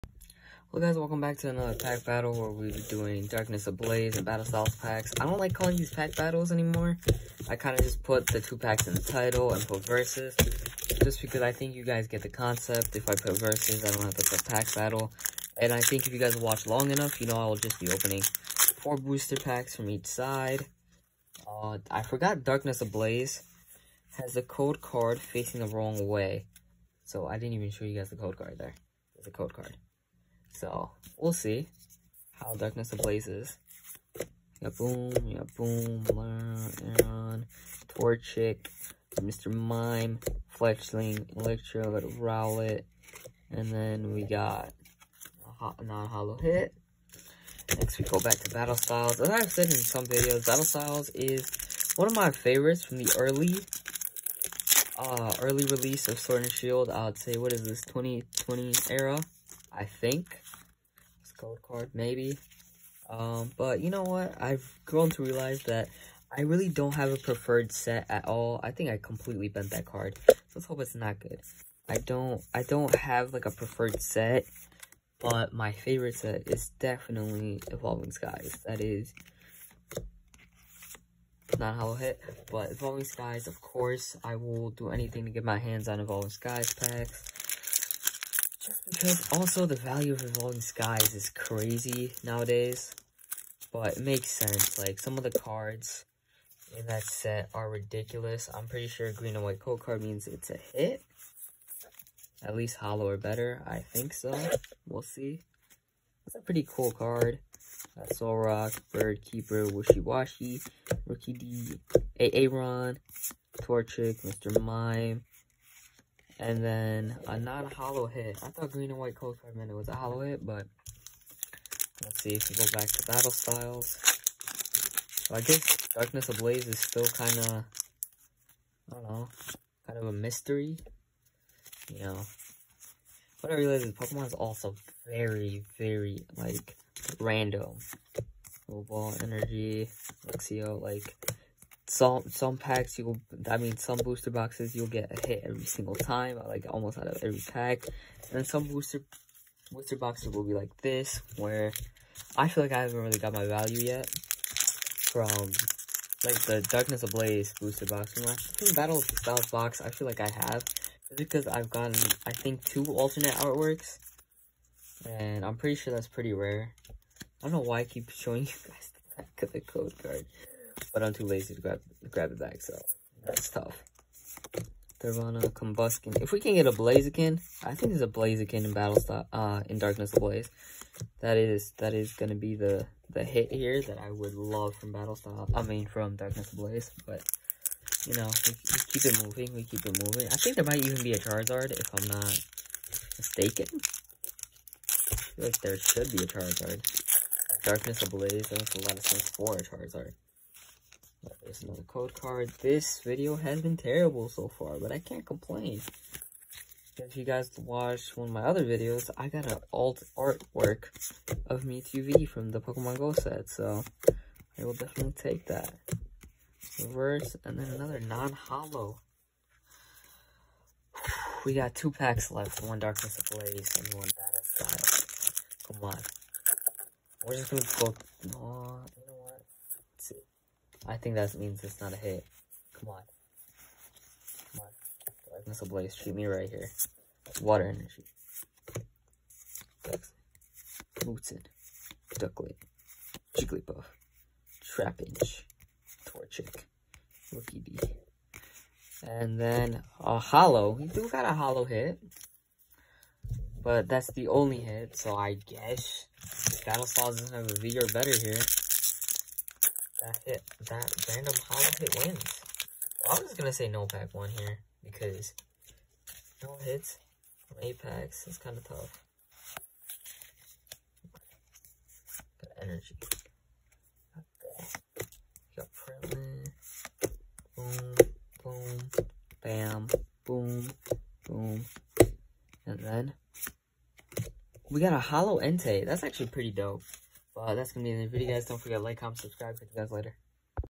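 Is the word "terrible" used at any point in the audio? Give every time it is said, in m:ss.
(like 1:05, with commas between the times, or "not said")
3:23.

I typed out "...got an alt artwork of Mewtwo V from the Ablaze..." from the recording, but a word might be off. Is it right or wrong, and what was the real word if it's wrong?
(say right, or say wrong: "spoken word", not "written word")
wrong: "Pokemon", not "Ablaze".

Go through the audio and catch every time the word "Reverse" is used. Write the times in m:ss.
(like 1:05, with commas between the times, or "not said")
3:36.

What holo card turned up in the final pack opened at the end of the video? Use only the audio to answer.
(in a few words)
Entei.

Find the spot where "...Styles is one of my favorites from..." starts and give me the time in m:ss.
0:50.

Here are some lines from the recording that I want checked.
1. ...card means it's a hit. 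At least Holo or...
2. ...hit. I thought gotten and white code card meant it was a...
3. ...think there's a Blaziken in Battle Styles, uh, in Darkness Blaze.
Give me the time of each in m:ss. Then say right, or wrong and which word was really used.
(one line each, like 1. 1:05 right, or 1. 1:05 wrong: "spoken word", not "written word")
1. 1:39 right
2. 1:58 wrong: "green", not "gotten"
3. 2:57 right.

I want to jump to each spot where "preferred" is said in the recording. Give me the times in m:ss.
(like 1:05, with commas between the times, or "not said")
1:07, 1:13.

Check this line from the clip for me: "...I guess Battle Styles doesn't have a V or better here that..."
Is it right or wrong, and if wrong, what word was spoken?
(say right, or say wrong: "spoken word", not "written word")
right.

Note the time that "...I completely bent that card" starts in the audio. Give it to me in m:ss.
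1:08.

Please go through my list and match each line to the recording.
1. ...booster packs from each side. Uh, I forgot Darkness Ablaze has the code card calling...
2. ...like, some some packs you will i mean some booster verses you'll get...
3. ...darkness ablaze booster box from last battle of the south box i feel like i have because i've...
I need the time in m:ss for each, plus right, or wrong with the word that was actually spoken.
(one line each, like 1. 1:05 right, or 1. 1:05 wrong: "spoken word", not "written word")
1. 0:18 wrong: "facing", not "calling"
2. 2:20 wrong: "boxes", not "verses"
3. 2:36 right.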